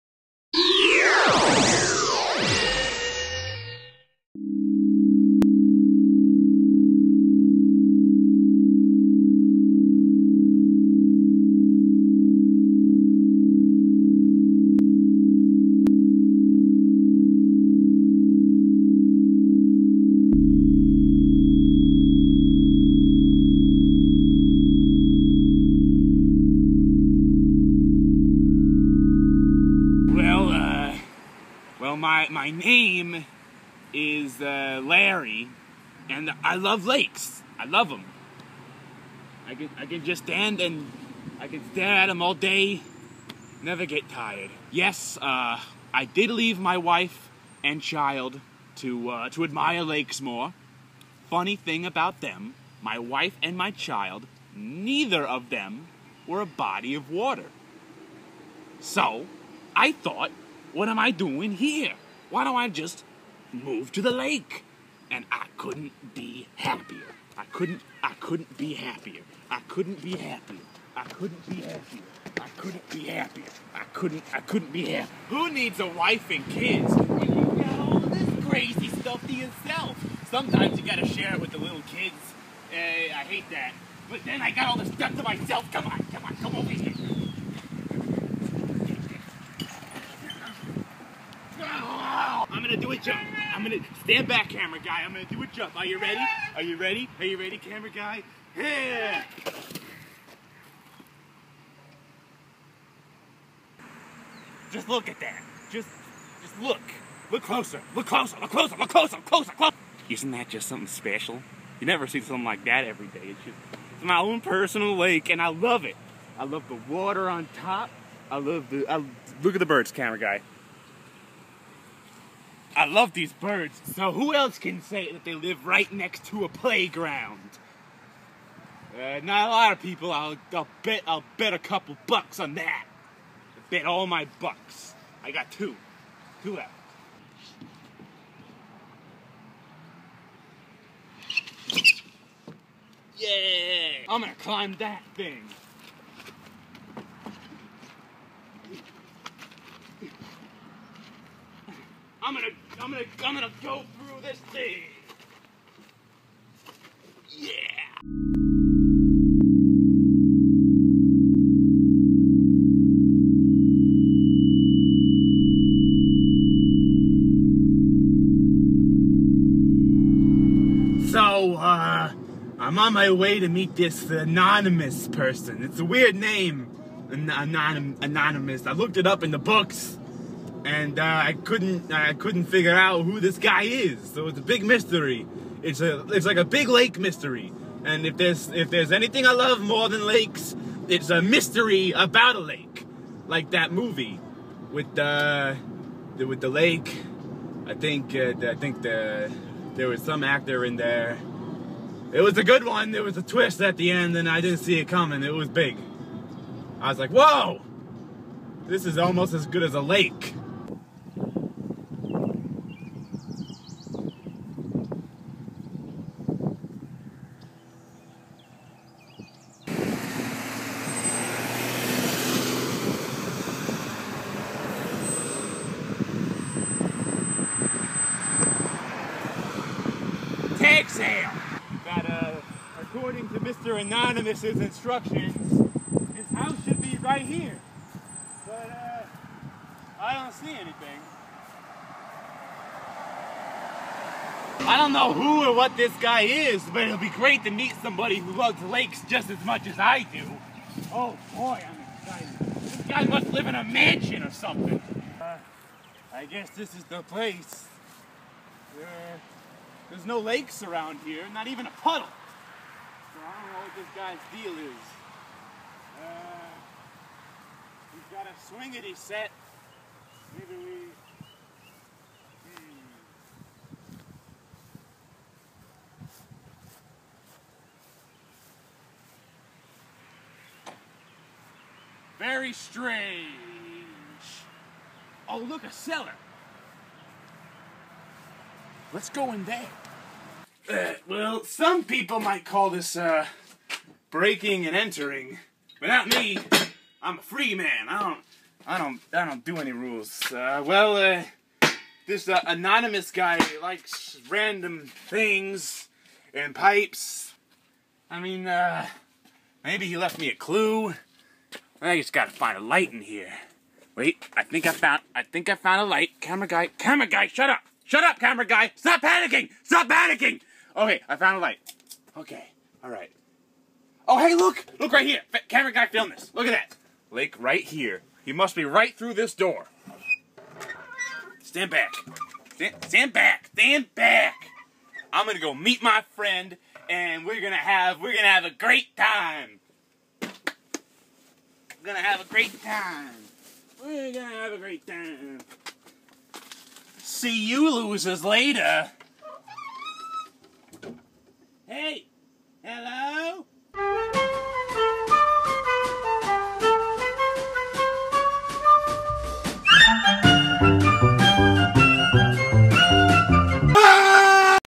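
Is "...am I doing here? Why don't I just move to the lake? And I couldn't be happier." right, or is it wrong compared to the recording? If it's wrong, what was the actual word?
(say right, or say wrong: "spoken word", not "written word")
right.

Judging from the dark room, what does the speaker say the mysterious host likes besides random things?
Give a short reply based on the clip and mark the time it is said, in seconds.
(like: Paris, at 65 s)
Pipes, at 306 s.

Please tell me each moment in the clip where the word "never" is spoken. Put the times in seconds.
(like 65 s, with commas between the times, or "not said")
43 s, 111 s.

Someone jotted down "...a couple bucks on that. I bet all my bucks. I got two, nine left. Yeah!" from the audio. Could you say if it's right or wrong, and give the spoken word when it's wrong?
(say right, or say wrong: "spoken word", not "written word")
wrong: "two", not "nine".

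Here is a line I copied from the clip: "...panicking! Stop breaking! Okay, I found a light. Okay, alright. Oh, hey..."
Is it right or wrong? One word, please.
wrong.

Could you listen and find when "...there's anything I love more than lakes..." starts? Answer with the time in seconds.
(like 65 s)
188 s.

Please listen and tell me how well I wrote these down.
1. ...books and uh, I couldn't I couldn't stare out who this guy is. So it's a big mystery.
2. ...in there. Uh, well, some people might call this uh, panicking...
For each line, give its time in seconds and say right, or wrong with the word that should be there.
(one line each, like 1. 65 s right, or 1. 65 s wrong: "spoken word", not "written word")
1. 179 s wrong: "figure", not "stare"
2. 289 s wrong: "breaking", not "panicking".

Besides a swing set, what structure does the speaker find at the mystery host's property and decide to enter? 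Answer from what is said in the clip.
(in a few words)
A cellar.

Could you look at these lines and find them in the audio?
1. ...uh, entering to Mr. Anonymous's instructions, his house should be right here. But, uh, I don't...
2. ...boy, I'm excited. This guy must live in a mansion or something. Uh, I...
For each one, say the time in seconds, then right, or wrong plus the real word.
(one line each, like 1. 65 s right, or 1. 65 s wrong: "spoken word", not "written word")
1. 232 s wrong: "according", not "entering"
2. 251 s right.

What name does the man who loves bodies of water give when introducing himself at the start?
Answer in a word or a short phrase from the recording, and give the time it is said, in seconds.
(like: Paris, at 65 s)
Larry, at 34 s.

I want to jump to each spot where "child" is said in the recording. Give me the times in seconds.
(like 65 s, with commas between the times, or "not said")
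47 s, 53 s.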